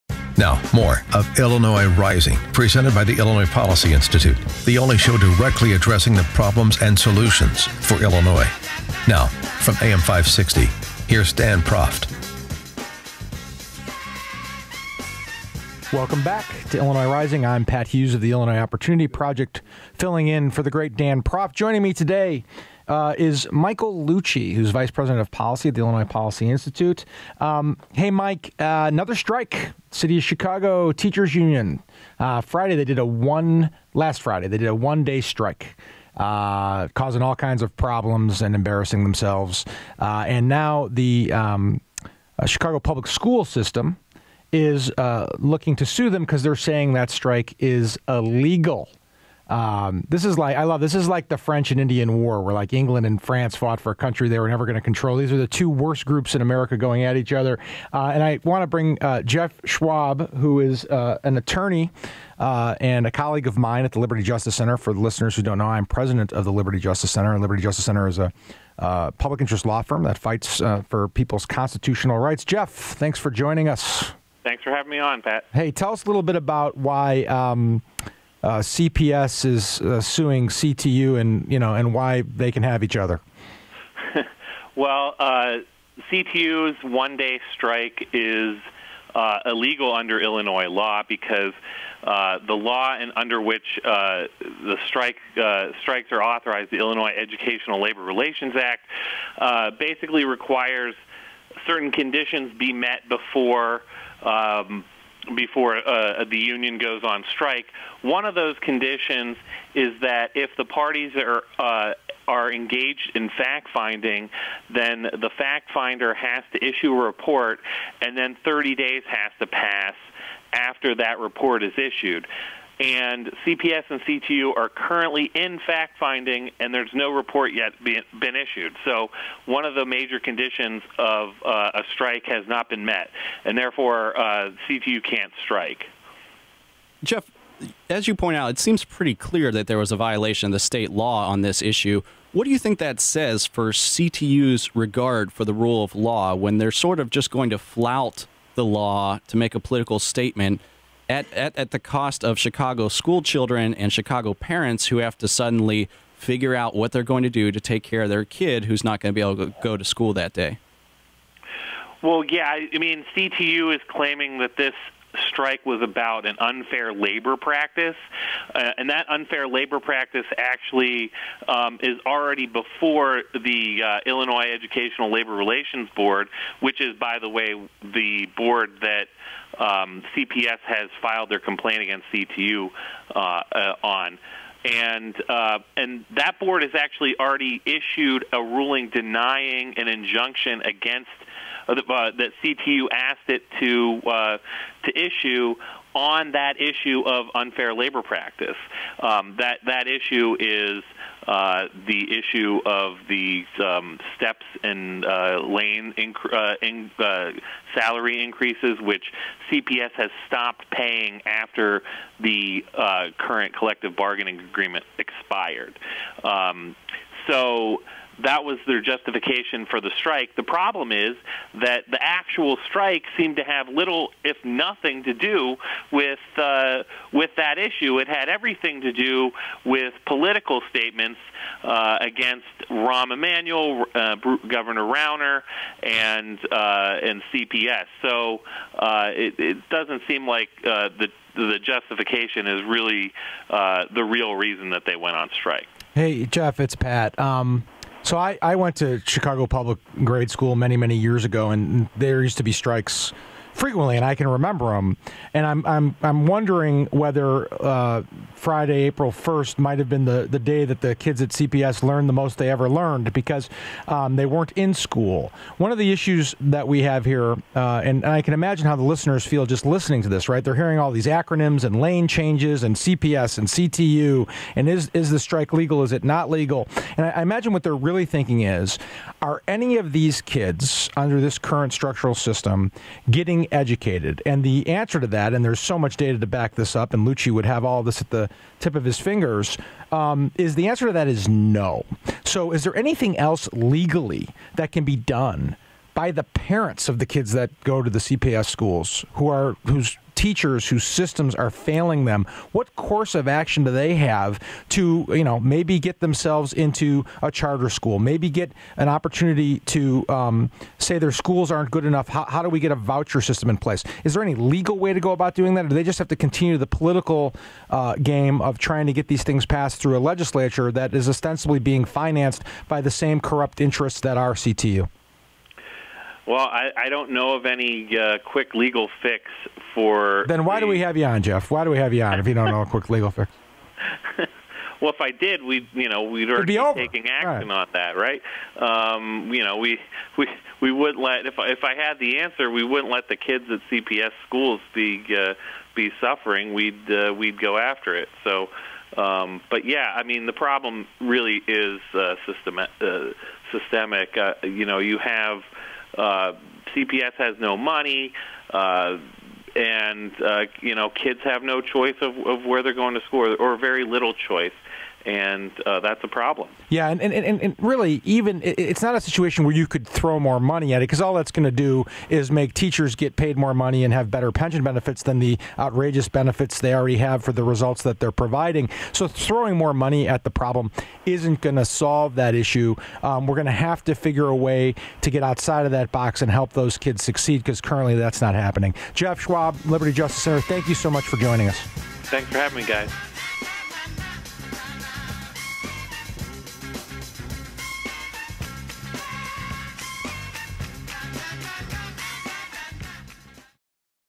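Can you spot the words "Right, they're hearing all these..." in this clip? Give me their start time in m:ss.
4:30.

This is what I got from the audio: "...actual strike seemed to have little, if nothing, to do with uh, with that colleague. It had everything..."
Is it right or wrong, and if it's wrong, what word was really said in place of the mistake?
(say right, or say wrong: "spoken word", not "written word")
wrong: "issue", not "colleague".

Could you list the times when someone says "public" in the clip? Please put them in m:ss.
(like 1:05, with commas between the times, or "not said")
0:42, 1:09, 4:09.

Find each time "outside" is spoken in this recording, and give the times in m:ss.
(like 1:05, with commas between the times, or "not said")
6:25.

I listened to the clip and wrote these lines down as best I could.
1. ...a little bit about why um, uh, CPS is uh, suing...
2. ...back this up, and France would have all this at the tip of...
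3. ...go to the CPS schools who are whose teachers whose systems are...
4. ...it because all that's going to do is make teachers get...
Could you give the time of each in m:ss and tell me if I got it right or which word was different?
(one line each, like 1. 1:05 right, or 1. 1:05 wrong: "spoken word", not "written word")
1. 1:16 right
2. 4:46 wrong: "Lucci", not "France"
3. 4:57 right
4. 6:10 right.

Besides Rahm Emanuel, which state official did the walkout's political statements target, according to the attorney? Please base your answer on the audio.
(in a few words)
Governor Rauner.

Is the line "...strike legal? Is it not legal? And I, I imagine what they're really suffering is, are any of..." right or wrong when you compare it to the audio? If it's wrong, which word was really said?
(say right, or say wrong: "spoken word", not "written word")
wrong: "thinking", not "suffering".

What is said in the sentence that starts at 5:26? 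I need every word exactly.
Well, I, I don't know of any uh, quick legal fix for.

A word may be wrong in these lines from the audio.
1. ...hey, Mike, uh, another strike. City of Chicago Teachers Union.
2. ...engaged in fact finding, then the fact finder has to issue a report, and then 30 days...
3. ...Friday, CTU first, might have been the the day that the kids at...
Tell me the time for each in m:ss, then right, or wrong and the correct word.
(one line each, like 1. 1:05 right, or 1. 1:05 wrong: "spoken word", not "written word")
1. 0:27 right
2. 1:52 right
3. 4:18 wrong: "April", not "CTU".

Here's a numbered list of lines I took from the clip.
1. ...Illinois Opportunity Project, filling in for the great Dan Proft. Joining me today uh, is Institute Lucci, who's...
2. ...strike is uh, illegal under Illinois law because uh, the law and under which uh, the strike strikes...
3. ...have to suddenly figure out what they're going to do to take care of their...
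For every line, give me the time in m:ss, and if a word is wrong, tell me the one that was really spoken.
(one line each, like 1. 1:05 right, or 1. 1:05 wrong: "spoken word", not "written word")
1. 0:18 wrong: "Michael", not "Institute"
2. 1:27 right
3. 2:34 right.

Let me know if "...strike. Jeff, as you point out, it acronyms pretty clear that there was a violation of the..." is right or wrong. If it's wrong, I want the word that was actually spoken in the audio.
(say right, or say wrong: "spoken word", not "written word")
wrong: "seems", not "acronyms".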